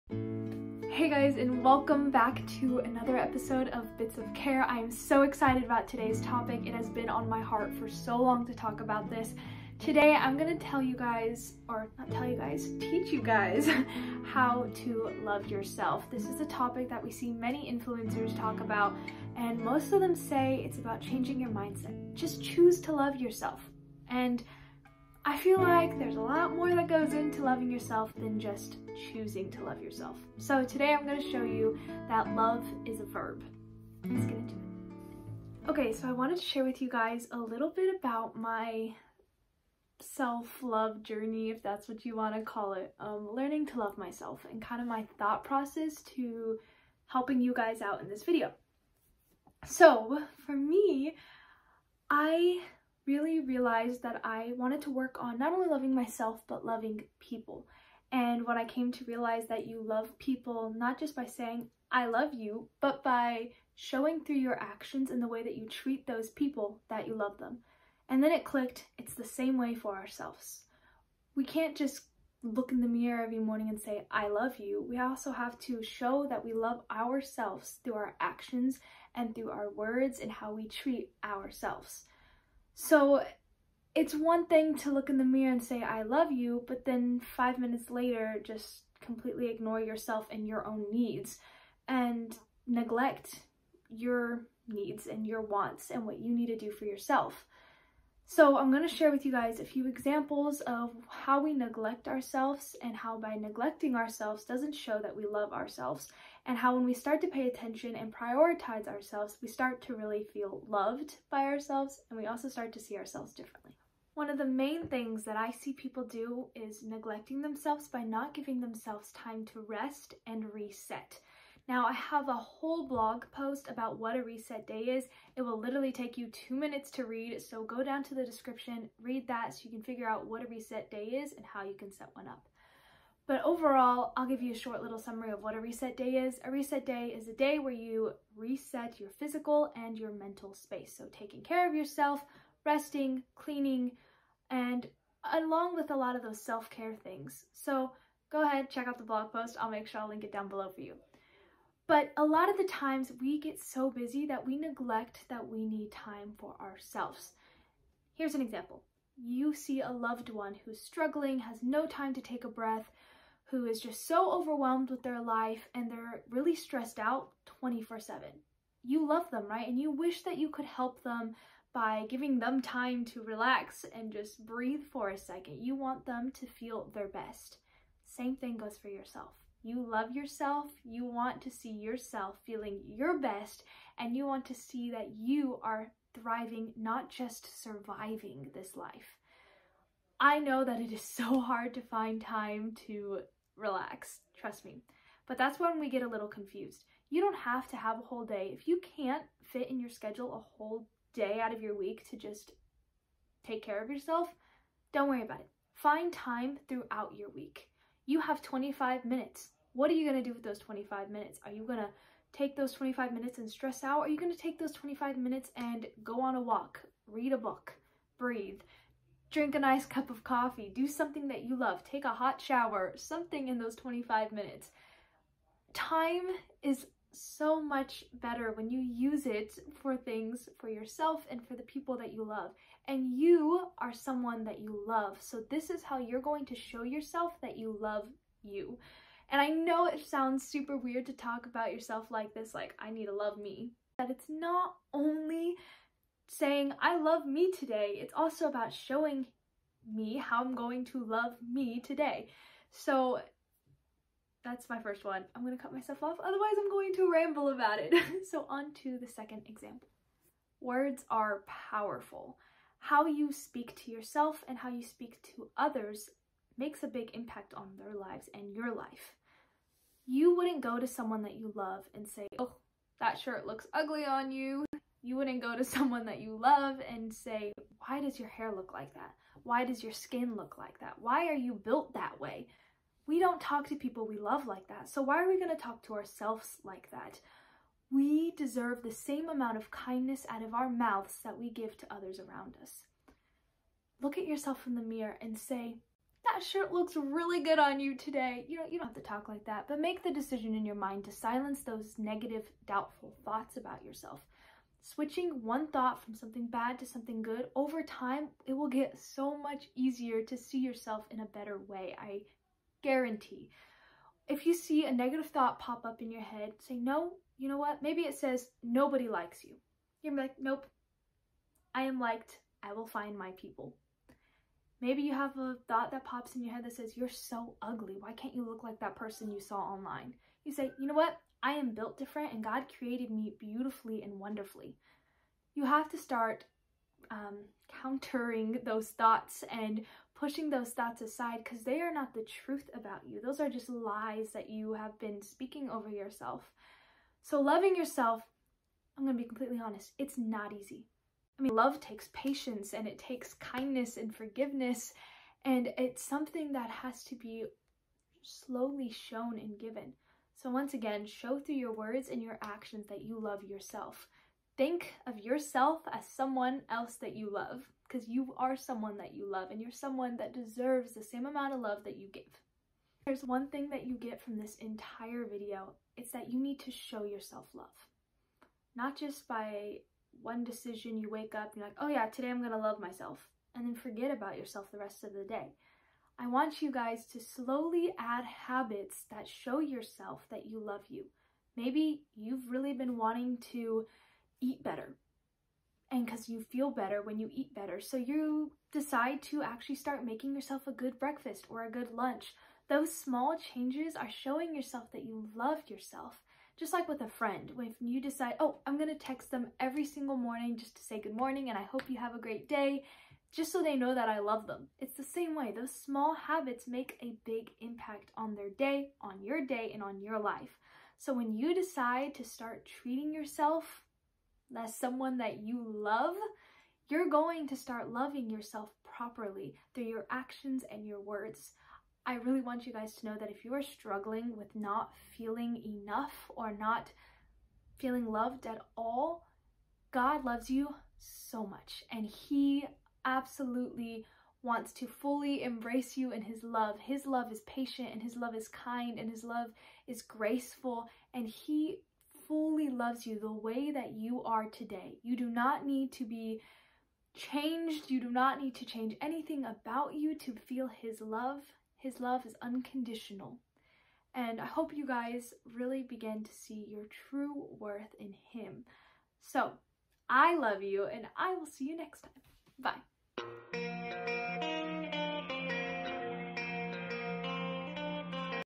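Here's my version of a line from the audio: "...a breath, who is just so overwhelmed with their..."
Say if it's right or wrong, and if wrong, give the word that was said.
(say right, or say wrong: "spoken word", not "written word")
right.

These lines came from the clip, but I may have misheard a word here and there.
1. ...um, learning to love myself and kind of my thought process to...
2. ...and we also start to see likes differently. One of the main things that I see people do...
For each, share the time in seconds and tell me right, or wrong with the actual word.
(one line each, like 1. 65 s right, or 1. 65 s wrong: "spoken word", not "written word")
1. 42 s right
2. 112 s wrong: "ourselves", not "likes".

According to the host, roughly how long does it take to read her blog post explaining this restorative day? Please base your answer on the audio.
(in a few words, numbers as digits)
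2 minutes.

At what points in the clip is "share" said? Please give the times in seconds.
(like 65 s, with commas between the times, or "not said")
36 s, 98 s.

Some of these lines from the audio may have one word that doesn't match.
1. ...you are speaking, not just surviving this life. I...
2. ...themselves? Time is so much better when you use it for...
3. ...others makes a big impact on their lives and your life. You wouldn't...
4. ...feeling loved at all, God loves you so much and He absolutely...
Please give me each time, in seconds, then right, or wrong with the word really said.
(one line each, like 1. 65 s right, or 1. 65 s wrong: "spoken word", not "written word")
1. 185 s wrong: "thriving", not "speaking"
2. 224 s wrong: "minutes", not "themselves"
3. 265 s right
4. 437 s right.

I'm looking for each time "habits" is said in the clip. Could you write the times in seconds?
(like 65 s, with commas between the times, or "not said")
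388 s, 416 s.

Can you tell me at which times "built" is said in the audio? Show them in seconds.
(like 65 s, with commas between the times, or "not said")
281 s, 331 s.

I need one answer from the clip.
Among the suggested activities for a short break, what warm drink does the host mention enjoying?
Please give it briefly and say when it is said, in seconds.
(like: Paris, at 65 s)
coffee, at 219 s.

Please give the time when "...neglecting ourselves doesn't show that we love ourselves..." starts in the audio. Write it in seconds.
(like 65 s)
103 s.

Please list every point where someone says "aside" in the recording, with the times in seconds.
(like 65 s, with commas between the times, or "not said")
341 s.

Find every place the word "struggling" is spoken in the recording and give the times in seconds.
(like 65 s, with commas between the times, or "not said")
160 s, 433 s.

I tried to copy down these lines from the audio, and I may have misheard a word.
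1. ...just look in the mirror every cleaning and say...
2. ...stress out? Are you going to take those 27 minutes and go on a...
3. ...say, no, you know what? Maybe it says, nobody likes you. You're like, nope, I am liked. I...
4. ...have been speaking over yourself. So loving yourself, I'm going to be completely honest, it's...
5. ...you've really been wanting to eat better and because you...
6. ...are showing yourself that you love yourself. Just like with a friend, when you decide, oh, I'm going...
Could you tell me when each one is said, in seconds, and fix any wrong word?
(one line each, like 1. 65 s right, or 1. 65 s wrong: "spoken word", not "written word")
1. 71 s wrong: "morning", not "cleaning"
2. 213 s wrong: "25", not "27"
3. 316 s right
4. 344 s right
5. 392 s right
6. 403 s right.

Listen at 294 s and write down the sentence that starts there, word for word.
Look at yourself in the mirror and say, that shirt looks really good on you today.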